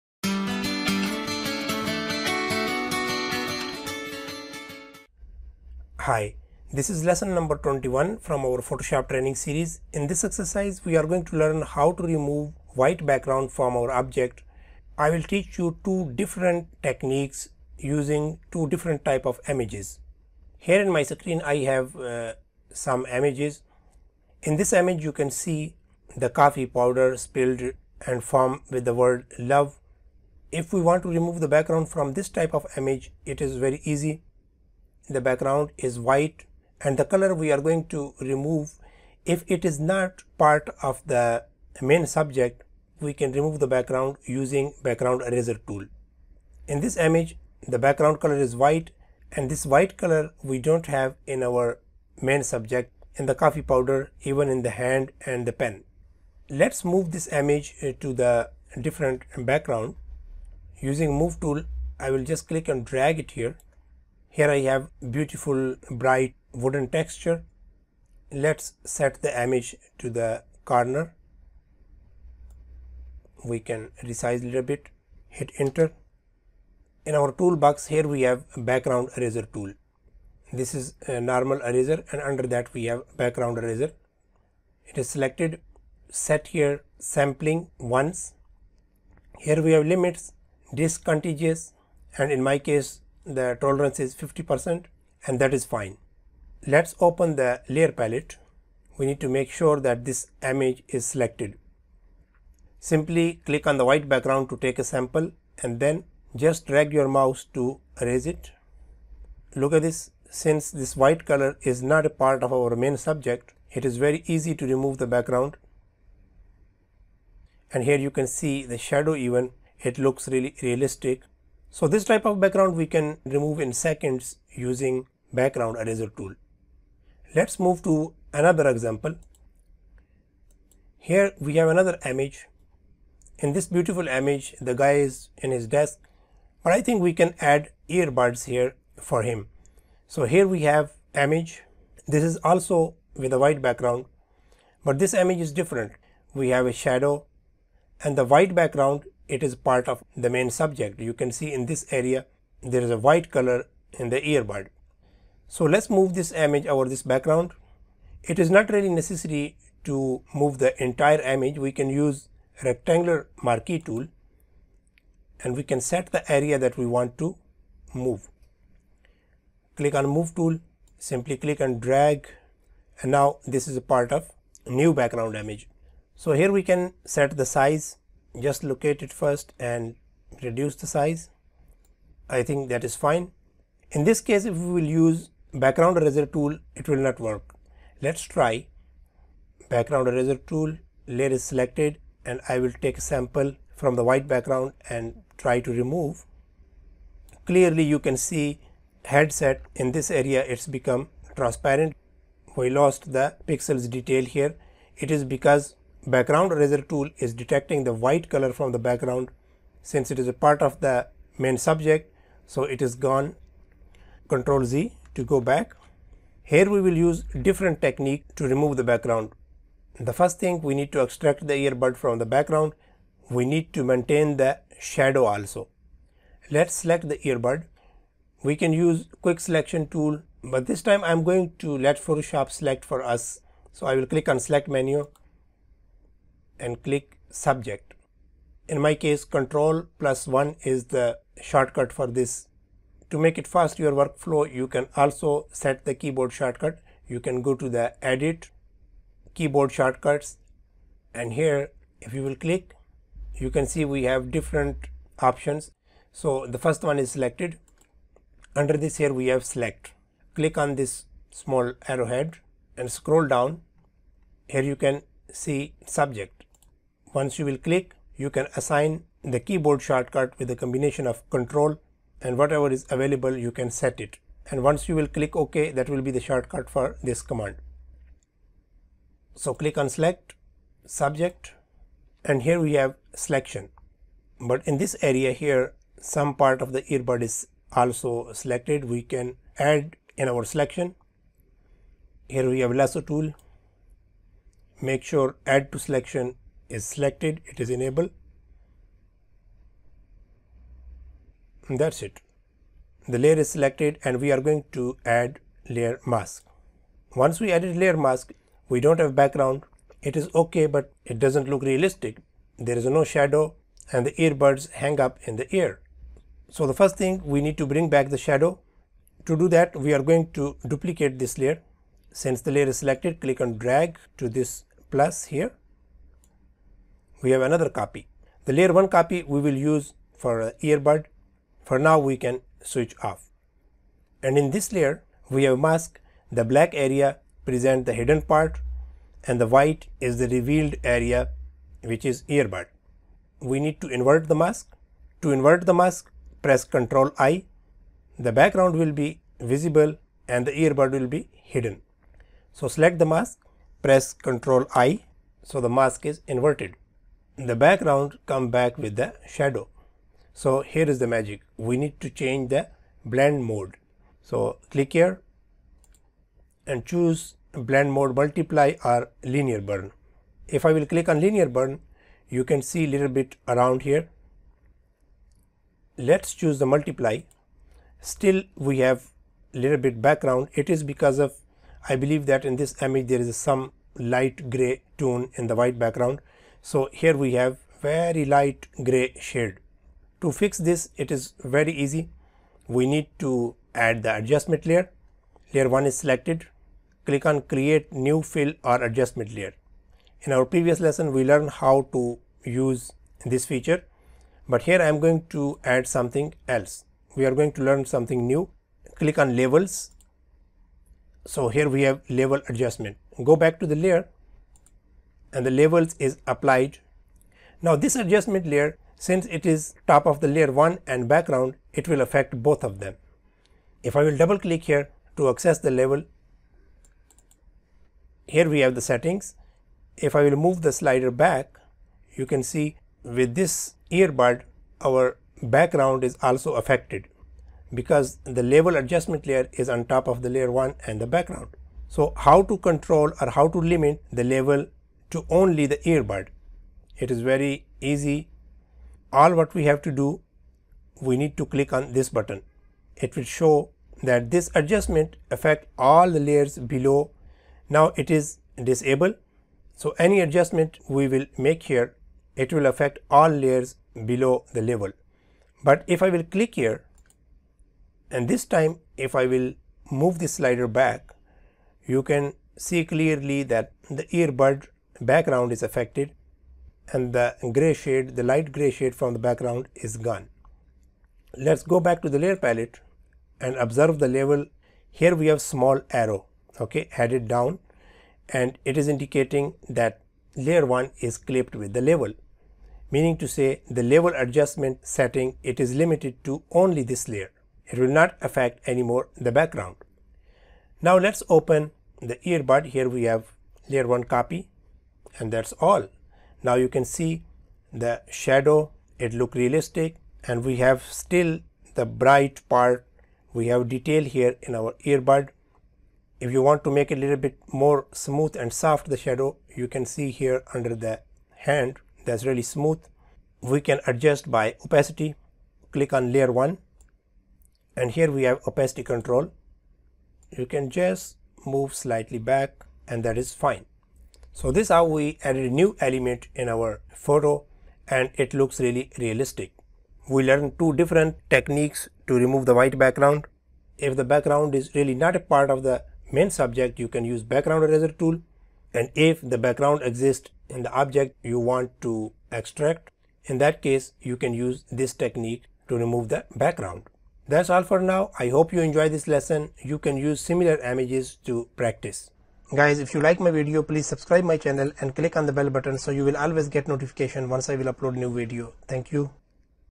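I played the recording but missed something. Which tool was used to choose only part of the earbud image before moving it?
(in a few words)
rectangular marquee tool.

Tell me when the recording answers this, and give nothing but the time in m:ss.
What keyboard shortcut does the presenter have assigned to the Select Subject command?
3:59.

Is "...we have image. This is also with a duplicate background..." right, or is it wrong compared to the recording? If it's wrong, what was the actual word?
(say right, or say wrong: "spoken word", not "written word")
wrong: "white", not "duplicate".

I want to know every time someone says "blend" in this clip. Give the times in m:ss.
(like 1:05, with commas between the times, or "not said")
6:03, 6:07.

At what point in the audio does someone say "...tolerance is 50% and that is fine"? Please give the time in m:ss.
1:33.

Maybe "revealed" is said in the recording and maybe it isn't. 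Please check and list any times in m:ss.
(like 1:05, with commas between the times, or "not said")
5:40.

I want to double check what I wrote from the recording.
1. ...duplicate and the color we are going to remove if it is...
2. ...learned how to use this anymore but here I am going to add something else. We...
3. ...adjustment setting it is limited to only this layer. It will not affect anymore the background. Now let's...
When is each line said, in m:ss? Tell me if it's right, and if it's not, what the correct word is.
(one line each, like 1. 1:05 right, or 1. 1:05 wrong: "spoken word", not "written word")
1. 0:35 wrong: "white", not "duplicate"
2. 6:41 wrong: "feature", not "anymore"
3. 8:14 right.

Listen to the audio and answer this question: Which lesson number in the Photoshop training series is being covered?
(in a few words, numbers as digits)
21.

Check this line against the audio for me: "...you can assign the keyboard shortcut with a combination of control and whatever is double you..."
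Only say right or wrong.
wrong.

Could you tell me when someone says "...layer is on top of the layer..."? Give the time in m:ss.
7:19.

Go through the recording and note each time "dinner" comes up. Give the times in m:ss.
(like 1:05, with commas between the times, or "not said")
not said.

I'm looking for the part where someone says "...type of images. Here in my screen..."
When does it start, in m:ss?
0:19.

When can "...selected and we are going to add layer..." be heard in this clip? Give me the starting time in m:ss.
5:03.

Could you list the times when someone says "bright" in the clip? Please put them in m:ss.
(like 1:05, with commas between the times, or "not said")
1:06, 8:31.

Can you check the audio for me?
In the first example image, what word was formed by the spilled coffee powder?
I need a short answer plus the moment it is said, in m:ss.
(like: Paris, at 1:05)
love, at 0:29.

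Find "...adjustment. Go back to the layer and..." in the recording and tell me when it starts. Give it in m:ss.
6:52.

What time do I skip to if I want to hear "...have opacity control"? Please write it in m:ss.
8:48.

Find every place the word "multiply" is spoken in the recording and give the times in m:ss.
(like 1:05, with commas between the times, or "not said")
6:08, 6:16.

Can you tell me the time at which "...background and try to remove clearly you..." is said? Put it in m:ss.
3:14.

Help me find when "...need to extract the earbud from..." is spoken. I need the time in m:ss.
3:40.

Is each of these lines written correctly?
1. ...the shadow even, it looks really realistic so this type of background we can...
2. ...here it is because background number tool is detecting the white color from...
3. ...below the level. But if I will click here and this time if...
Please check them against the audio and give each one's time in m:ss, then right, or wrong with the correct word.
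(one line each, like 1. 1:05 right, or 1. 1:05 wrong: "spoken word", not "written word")
1. 1:58 right
2. 3:24 wrong: "eraser", not "number"
3. 7:44 right.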